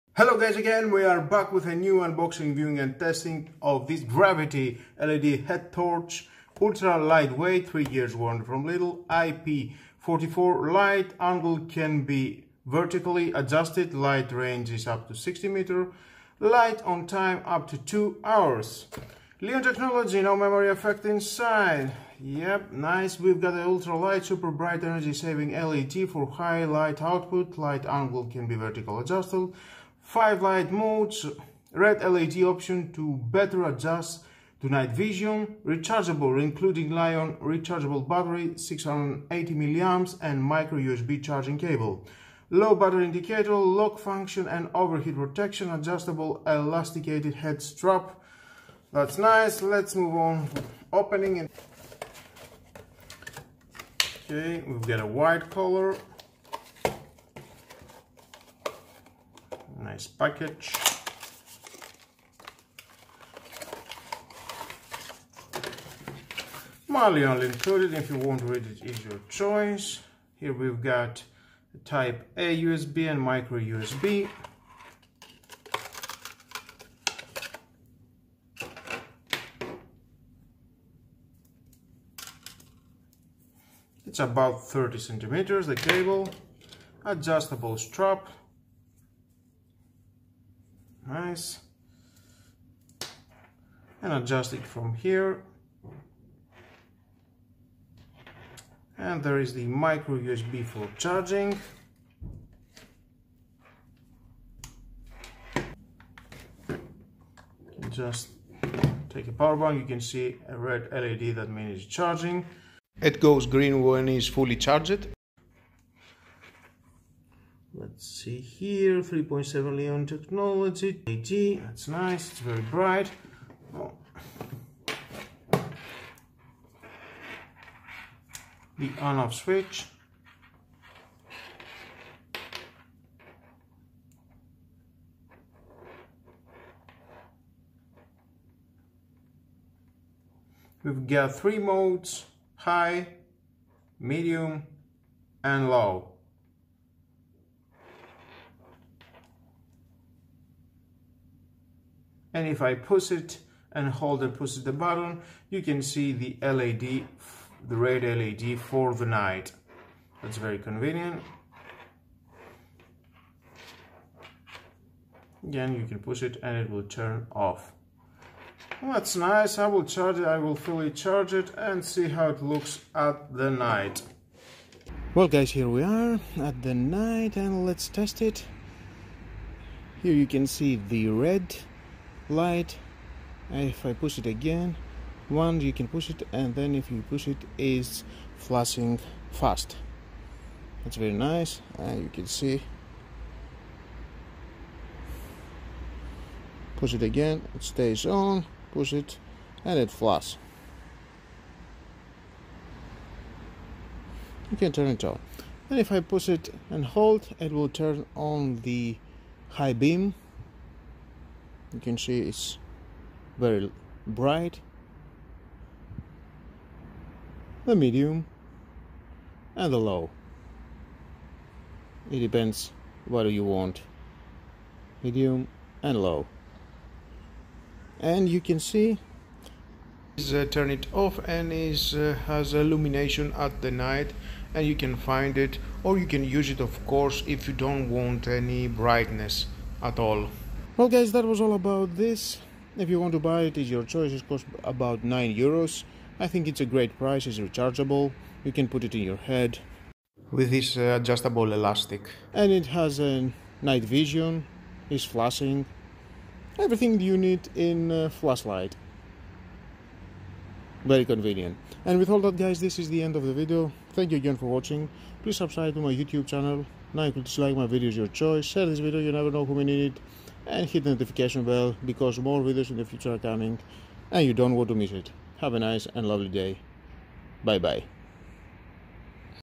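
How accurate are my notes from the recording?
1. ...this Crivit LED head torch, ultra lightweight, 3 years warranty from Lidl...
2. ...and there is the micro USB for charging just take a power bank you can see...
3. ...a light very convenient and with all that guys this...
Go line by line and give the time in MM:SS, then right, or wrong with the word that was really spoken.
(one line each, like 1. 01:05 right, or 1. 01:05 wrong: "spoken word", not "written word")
1. 00:03 right
2. 01:38 right
3. 04:17 wrong: "flashlight", not "light".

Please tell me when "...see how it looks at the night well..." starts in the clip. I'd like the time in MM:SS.
02:51.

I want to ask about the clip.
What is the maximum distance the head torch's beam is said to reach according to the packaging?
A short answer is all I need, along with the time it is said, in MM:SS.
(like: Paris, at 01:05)
60 meters, at 00:15.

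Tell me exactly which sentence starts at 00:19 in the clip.
Li-ion technology, no memory effect inside.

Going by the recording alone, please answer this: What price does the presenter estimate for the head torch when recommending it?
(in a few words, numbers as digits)
9 euros.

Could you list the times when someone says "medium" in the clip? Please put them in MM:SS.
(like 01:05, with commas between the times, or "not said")
02:23, 03:37, 03:45.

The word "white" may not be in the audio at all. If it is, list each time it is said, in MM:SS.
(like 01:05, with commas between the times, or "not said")
00:55.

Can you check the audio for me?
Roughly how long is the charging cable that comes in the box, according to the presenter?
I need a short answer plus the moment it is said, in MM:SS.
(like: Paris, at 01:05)
30 centimeters, at 01:24.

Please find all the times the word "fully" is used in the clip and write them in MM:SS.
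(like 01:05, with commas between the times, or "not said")
01:54, 02:50.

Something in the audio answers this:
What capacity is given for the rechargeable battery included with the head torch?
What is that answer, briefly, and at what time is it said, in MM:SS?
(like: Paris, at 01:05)
680 milliamps, at 00:38.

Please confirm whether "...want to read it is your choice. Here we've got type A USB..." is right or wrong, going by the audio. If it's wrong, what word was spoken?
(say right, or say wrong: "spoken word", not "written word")
right.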